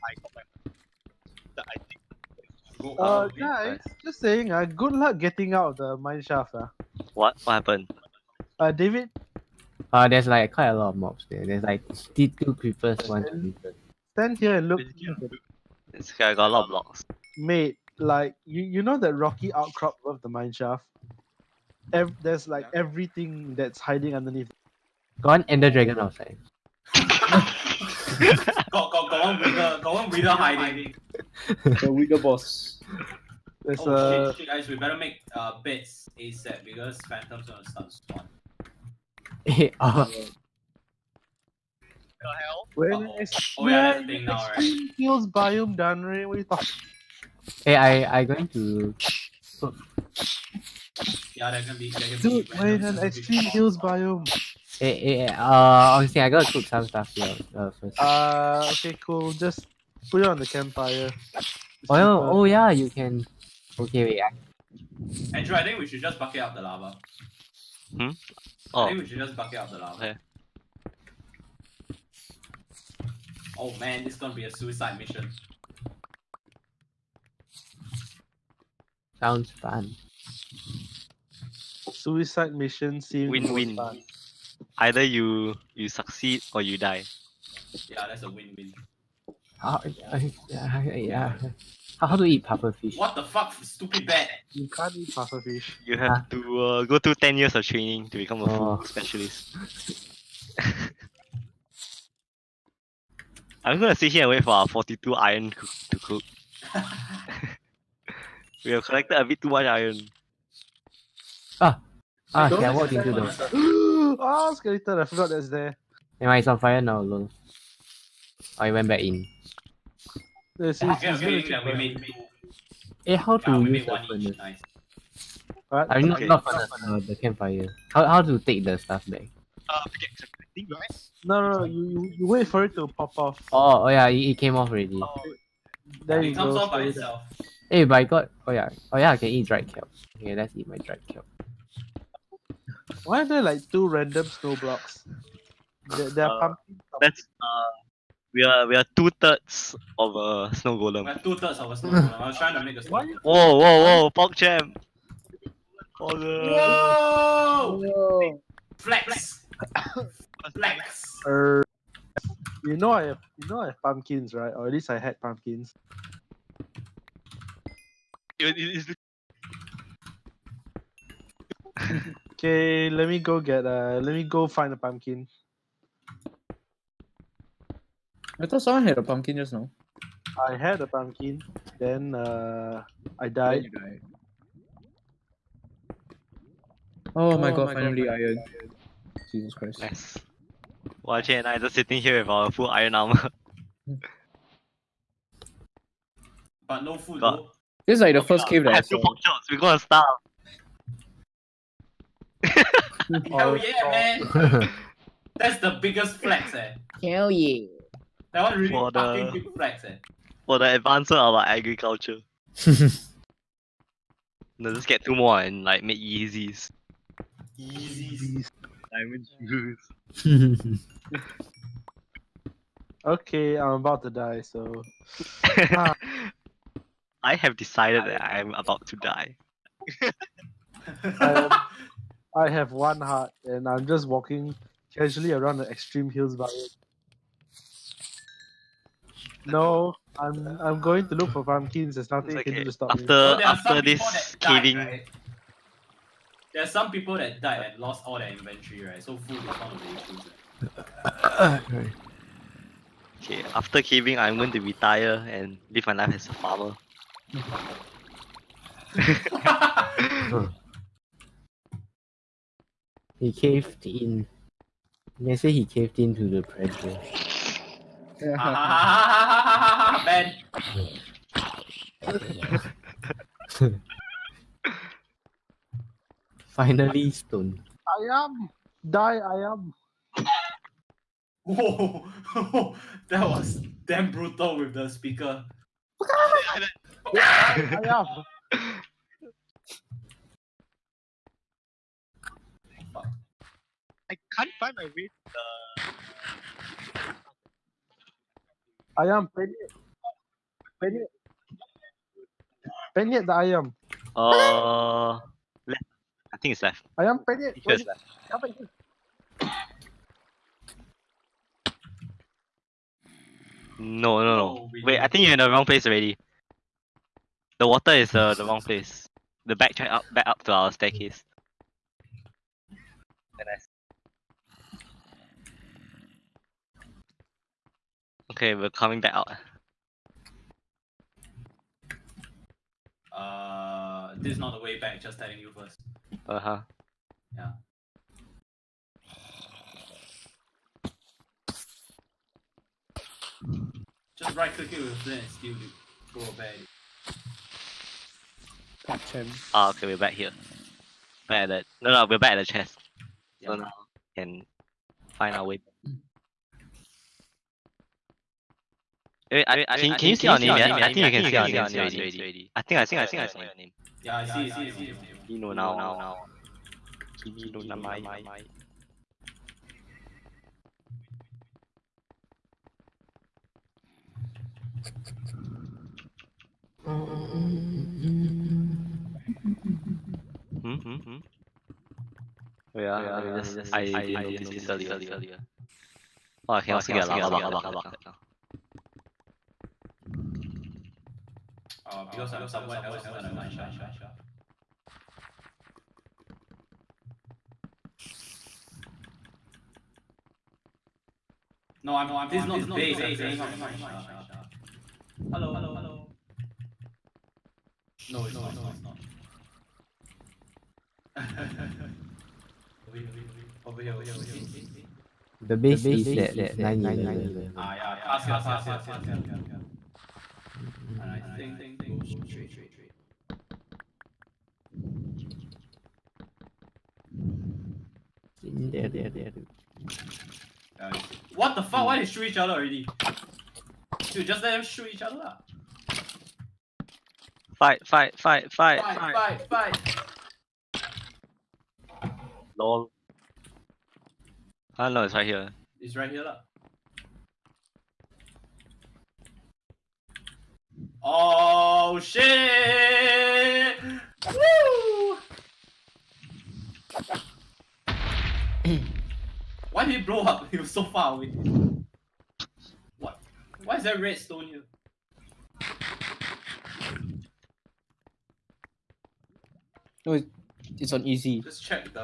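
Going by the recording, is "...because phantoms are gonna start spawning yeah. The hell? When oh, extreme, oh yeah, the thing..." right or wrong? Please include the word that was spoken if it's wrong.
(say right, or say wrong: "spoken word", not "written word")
right.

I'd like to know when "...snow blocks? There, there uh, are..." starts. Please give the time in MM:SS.
02:24.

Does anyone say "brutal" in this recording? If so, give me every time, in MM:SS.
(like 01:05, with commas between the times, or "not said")
04:44.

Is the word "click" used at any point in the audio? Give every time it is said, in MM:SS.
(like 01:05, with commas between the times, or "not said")
05:44.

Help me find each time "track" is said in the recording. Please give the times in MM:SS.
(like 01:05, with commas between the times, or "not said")
05:19.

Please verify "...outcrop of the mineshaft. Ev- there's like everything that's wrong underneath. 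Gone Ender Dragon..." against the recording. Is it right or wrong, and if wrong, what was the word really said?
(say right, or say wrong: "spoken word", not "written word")
wrong: "hiding", not "wrong".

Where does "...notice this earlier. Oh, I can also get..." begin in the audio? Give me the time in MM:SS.
06:24.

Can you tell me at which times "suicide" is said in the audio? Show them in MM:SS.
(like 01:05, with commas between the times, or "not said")
01:14, 01:21.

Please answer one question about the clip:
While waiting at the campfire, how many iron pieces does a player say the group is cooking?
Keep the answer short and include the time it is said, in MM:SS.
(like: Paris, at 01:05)
42, at 01:44.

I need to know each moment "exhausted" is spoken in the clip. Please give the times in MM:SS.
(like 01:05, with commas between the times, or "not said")
not said.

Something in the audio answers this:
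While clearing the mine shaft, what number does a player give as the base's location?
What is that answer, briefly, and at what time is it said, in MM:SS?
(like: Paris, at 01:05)
911, at 06:56.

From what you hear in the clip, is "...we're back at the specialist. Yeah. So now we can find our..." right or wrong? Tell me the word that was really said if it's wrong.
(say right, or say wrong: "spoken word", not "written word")
wrong: "chest", not "specialist".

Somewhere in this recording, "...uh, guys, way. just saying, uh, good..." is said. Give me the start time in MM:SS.
00:03.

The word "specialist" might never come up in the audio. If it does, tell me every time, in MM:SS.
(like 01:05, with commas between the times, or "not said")
01:38.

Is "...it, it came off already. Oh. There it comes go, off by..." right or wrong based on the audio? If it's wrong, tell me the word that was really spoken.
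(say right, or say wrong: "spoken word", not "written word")
right.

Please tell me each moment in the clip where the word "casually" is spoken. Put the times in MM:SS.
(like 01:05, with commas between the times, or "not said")
03:54.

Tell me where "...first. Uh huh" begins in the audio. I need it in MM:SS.
05:35.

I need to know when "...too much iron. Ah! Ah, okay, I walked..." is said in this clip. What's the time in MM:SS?
01:49.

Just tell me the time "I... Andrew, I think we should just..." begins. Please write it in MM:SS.
01:04.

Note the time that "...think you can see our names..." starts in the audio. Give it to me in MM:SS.
06:00.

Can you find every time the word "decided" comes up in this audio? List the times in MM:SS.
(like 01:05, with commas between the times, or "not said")
03:47.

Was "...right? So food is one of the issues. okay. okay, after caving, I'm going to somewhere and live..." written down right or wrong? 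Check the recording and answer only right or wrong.
wrong.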